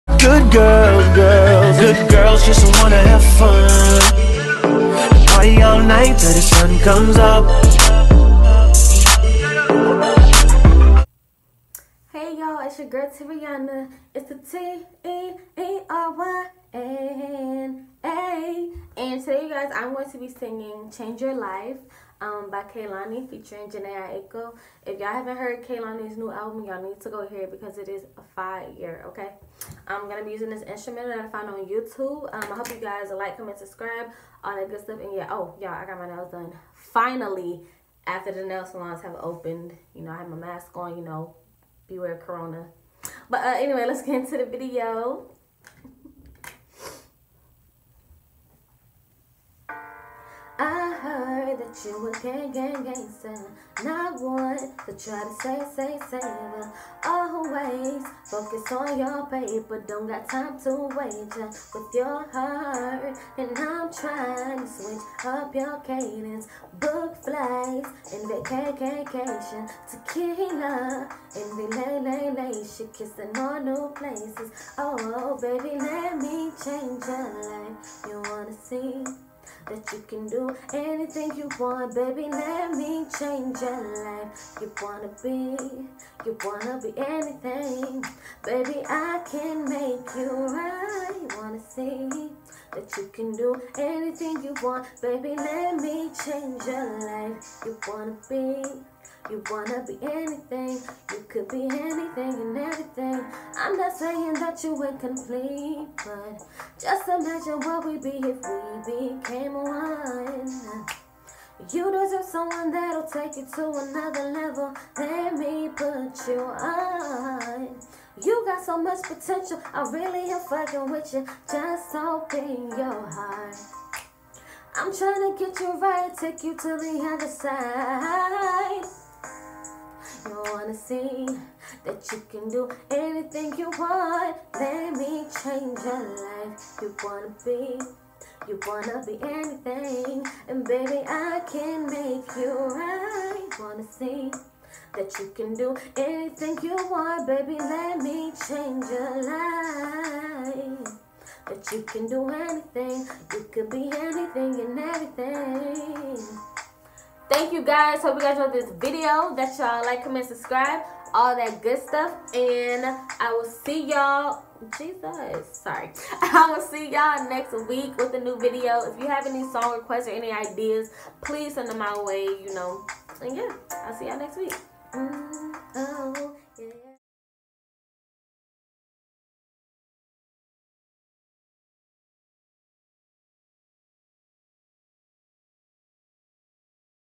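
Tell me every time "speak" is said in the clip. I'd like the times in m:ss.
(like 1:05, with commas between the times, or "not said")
not said.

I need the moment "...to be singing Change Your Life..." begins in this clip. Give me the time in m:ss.
0:20.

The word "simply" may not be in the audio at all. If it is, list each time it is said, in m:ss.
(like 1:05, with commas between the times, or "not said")
not said.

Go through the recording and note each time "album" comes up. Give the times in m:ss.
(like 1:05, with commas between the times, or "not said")
0:26.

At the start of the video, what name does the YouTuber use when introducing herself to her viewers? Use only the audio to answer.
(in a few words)
Teeryana.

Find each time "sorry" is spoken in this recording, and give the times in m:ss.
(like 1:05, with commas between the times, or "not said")
2:45.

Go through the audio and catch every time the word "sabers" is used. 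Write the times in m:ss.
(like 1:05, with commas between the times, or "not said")
not said.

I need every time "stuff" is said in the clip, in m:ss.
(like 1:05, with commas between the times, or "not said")
0:34, 2:41.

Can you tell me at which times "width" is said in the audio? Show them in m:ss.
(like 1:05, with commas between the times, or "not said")
not said.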